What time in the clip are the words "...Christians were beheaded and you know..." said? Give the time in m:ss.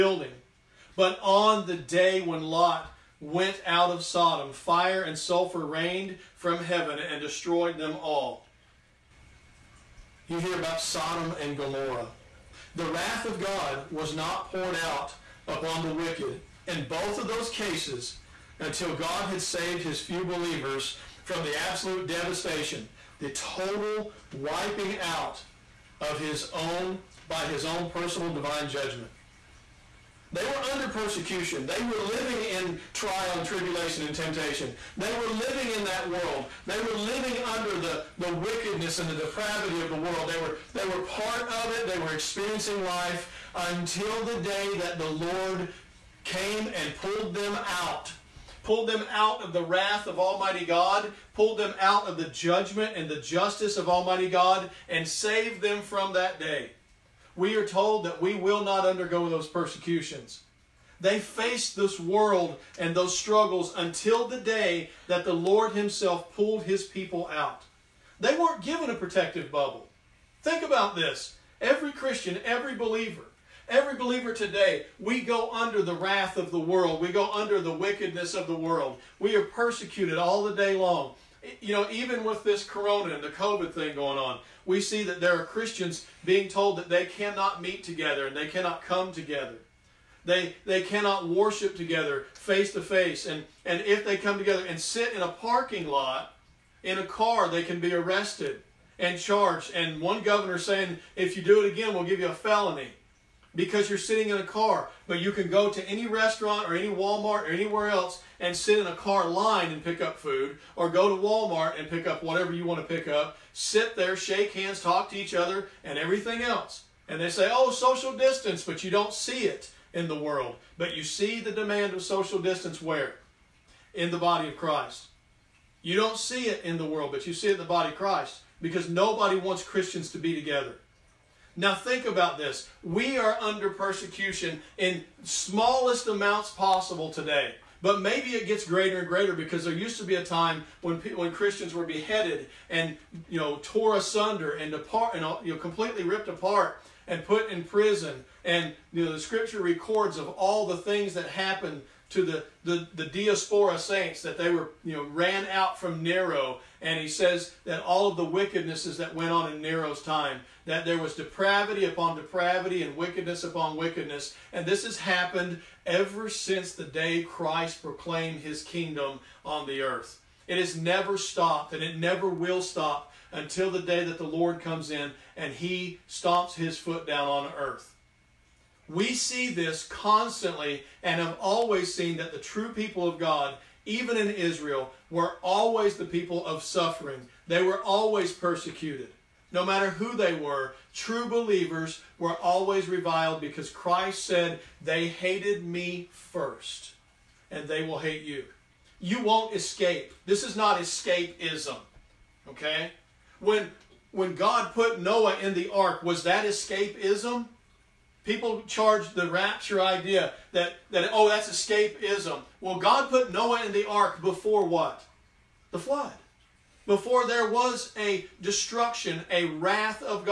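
2:21.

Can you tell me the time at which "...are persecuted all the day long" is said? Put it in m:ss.
1:19.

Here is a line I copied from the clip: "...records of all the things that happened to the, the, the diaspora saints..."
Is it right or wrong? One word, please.
right.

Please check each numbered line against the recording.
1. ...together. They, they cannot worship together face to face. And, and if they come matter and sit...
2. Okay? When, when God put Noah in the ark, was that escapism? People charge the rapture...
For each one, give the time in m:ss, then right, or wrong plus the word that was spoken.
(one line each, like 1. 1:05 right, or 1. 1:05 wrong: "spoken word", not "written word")
1. 1:29 wrong: "together", not "matter"
2. 3:22 right.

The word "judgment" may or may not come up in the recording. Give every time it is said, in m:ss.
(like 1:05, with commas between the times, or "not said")
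0:28, 0:52.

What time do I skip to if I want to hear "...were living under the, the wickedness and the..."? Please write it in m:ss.
0:36.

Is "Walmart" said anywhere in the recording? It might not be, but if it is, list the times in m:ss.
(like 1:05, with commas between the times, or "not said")
1:46, 1:51.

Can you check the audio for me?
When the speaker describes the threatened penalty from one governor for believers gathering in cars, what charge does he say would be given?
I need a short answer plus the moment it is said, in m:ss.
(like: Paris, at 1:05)
felony, at 1:42.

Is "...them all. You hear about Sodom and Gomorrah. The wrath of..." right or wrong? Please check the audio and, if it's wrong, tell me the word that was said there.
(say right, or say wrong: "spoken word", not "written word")
right.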